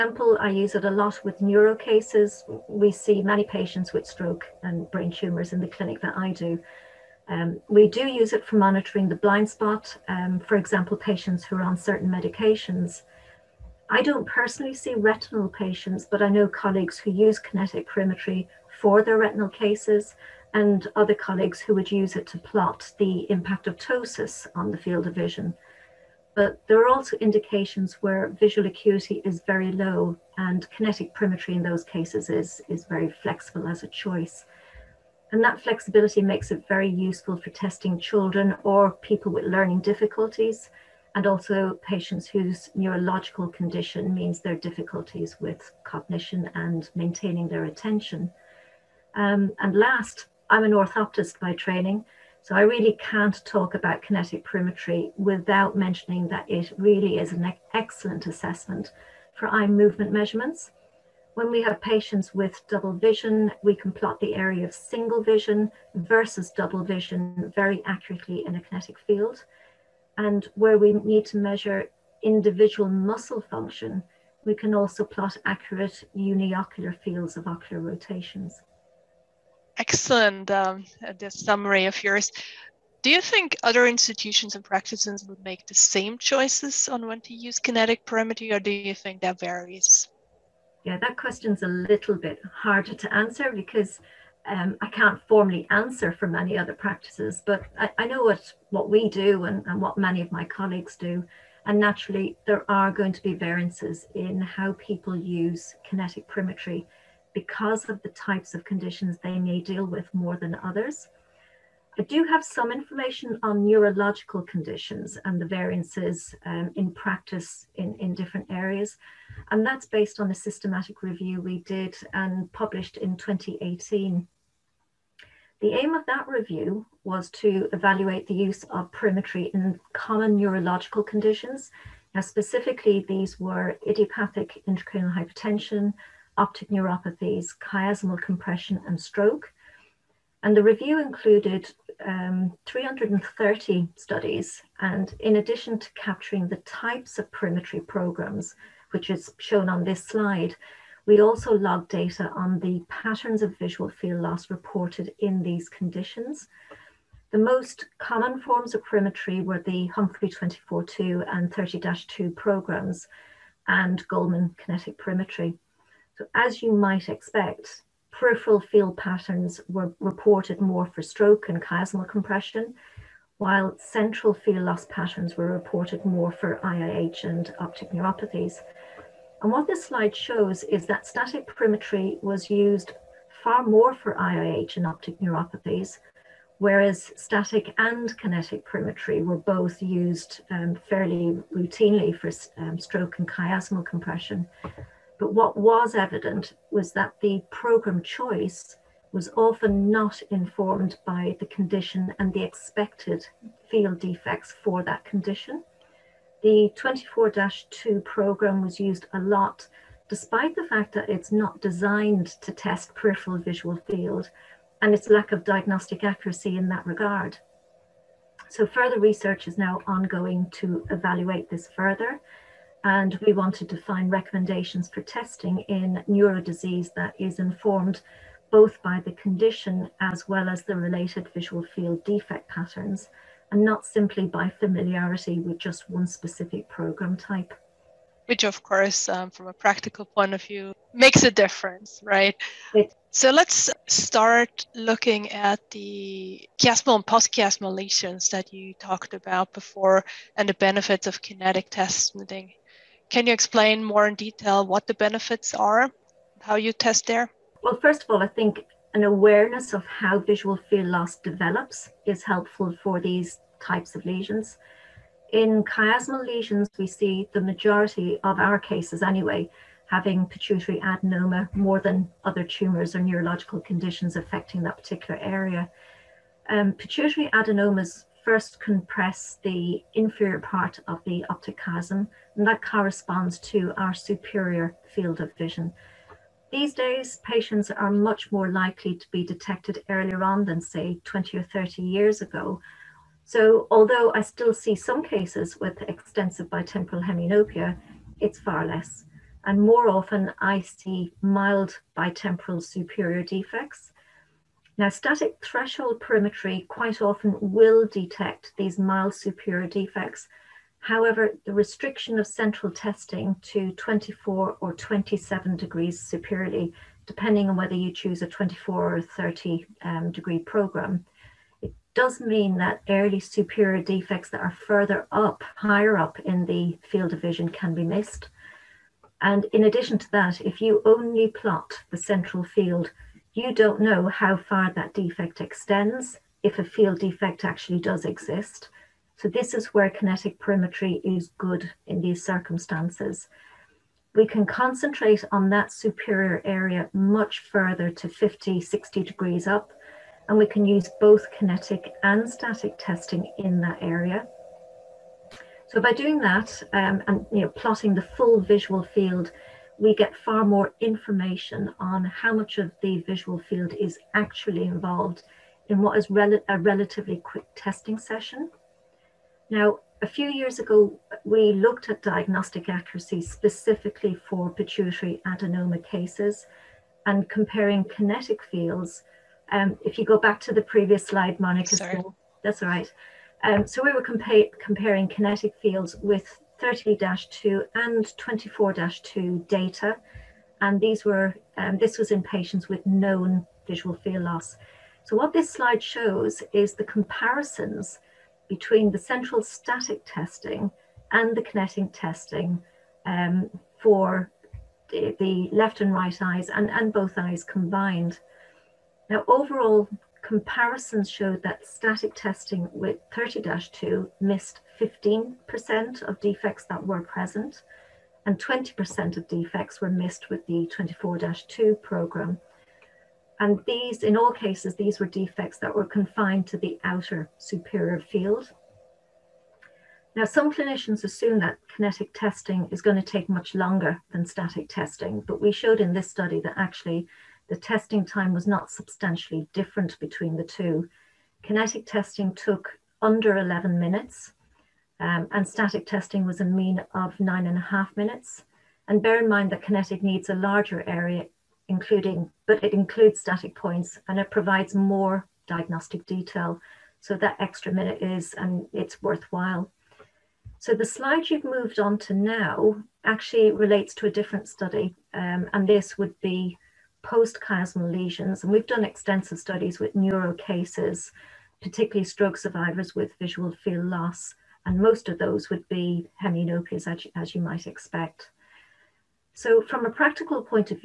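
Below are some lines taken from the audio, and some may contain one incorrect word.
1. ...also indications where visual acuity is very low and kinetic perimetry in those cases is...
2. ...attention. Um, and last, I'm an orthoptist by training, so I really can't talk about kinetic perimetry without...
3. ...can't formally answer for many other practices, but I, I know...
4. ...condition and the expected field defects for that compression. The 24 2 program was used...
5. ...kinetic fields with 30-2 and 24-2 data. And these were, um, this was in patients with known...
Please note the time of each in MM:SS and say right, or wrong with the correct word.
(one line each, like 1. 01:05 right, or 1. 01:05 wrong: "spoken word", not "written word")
1. 00:26 right
2. 00:47 right
3. 01:34 right
4. 03:21 wrong: "condition", not "compression"
5. 06:25 right.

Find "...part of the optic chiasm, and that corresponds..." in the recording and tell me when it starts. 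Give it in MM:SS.
04:40.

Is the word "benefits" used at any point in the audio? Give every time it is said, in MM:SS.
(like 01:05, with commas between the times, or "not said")
04:10, 04:14.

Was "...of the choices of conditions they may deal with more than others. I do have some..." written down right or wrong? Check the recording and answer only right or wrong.
wrong.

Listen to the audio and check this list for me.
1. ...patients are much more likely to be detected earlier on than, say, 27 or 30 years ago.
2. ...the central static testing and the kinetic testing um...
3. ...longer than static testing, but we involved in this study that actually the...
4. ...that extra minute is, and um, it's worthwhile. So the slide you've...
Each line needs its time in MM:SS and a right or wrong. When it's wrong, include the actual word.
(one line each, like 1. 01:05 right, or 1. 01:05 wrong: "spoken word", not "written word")
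1. 04:47 wrong: "20", not "27"
2. 06:38 right
3. 07:13 wrong: "showed", not "involved"
4. 07:37 right.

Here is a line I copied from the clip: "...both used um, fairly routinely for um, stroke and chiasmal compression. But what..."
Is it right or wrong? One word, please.
right.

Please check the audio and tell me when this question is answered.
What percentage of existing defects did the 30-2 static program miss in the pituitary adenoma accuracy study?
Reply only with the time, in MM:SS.
06:54.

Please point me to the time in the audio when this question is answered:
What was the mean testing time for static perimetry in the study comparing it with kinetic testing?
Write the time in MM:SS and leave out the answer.
07:27.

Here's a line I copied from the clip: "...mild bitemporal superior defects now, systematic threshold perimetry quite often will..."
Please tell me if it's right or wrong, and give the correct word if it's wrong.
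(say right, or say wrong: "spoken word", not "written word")
wrong: "static", not "systematic".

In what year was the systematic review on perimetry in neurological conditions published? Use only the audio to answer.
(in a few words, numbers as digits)
2018.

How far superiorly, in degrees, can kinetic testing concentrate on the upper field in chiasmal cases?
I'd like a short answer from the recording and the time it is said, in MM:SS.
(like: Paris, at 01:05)
50 to 60 degrees, at 05:48.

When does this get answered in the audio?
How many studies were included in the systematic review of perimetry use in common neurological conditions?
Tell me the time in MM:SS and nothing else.
02:22.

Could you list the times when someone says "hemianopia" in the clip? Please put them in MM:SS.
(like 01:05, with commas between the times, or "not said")
04:57, 07:56.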